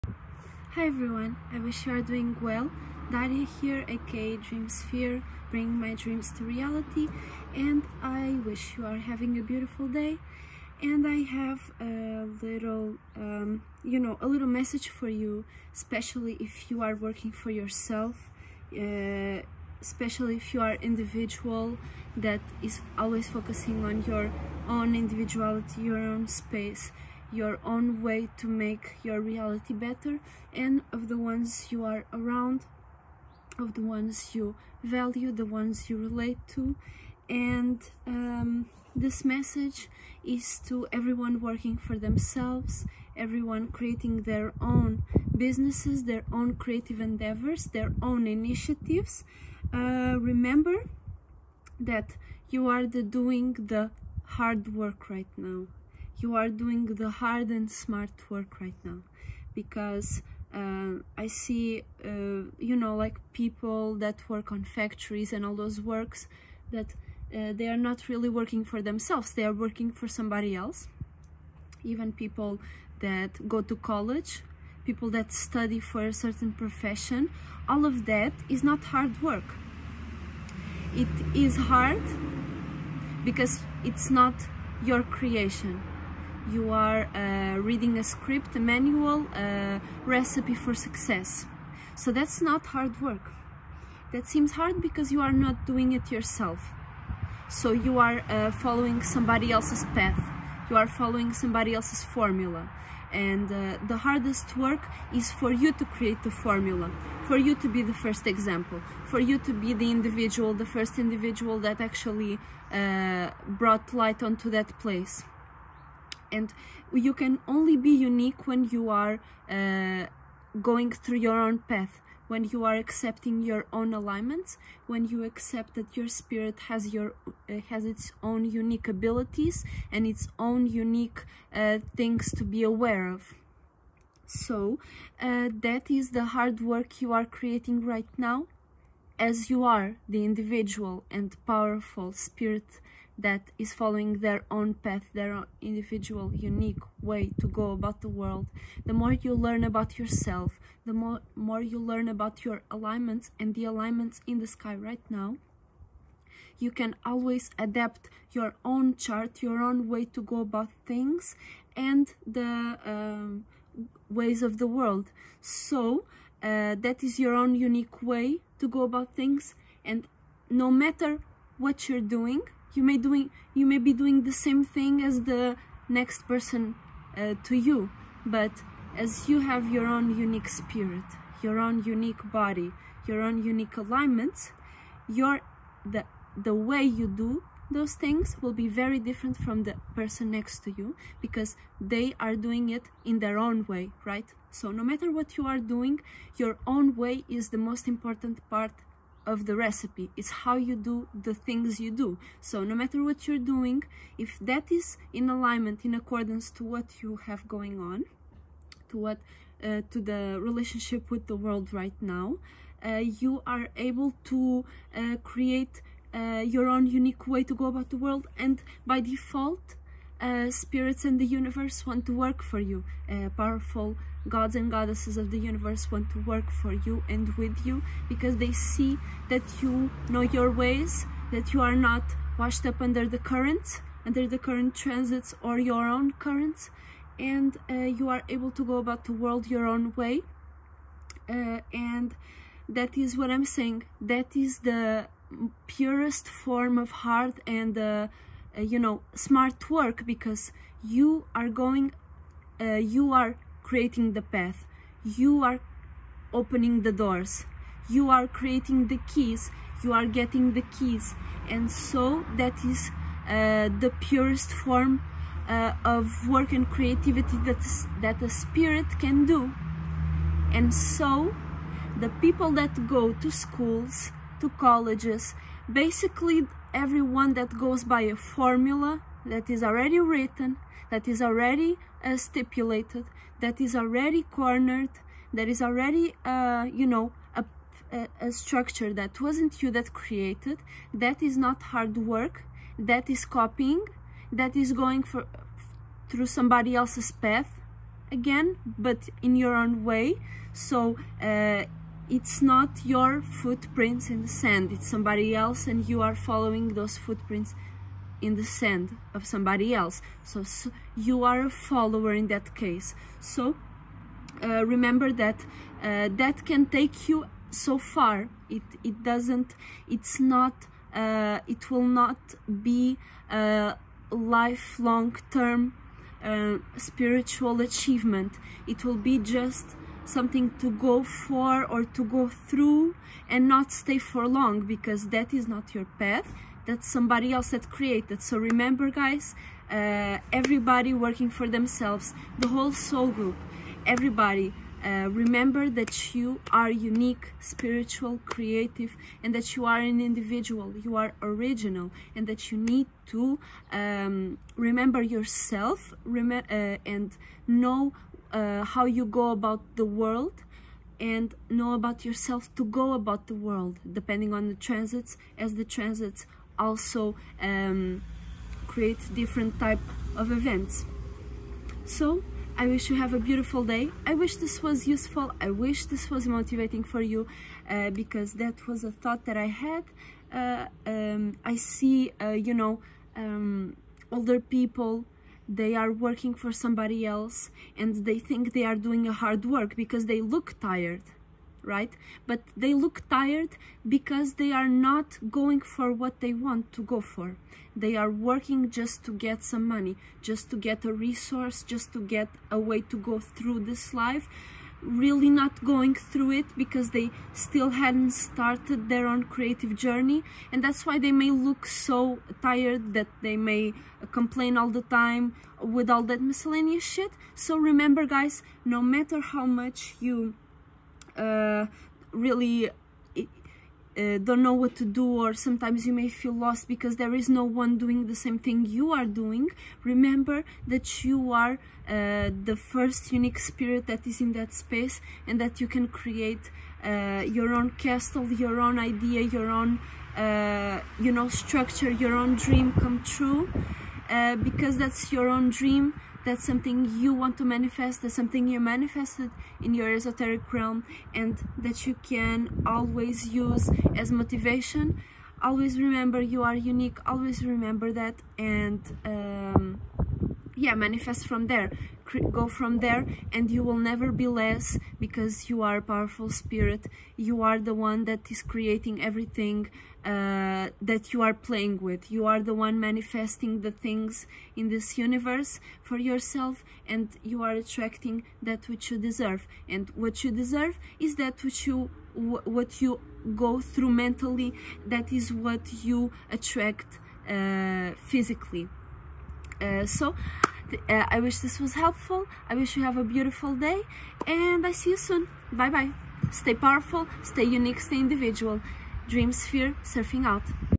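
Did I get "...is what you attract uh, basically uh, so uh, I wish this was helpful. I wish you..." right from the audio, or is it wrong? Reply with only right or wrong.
wrong.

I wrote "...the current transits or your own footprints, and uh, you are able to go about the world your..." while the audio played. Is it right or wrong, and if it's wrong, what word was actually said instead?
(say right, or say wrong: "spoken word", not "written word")
wrong: "currents", not "footprints".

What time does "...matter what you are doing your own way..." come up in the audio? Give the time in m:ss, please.
3:14.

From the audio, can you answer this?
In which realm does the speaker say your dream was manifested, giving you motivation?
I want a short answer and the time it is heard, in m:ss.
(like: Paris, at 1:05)
esoteric realm, at 7:29.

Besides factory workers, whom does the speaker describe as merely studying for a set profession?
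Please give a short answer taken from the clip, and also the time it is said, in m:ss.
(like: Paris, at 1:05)
people that go to college, at 1:12.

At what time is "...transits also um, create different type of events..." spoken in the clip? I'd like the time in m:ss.
6:05.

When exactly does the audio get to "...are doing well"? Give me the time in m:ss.
0:01.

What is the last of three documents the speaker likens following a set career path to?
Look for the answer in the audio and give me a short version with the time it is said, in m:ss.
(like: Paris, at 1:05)
recipe for success, at 1:30.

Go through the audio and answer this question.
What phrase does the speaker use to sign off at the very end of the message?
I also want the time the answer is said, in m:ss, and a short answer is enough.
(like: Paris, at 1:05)
Dream Sphere surfing out, at 8:19.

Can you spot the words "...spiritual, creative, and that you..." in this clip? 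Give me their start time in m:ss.
5:47.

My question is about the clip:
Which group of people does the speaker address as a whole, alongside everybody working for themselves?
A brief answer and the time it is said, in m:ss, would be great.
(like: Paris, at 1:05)
the whole soul group, at 5:42.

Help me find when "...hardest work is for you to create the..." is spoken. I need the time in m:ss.
1:43.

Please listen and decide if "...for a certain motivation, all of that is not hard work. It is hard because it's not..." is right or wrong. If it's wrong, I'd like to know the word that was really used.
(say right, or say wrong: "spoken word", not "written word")
wrong: "profession", not "motivation".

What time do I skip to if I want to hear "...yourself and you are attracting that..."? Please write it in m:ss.
7:55.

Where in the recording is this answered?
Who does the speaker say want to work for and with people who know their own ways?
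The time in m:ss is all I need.
3:44.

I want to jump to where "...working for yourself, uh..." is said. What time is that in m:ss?
0:16.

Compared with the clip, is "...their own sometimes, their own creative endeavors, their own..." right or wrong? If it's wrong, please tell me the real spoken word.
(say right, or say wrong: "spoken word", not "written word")
wrong: "businesses", not "sometimes".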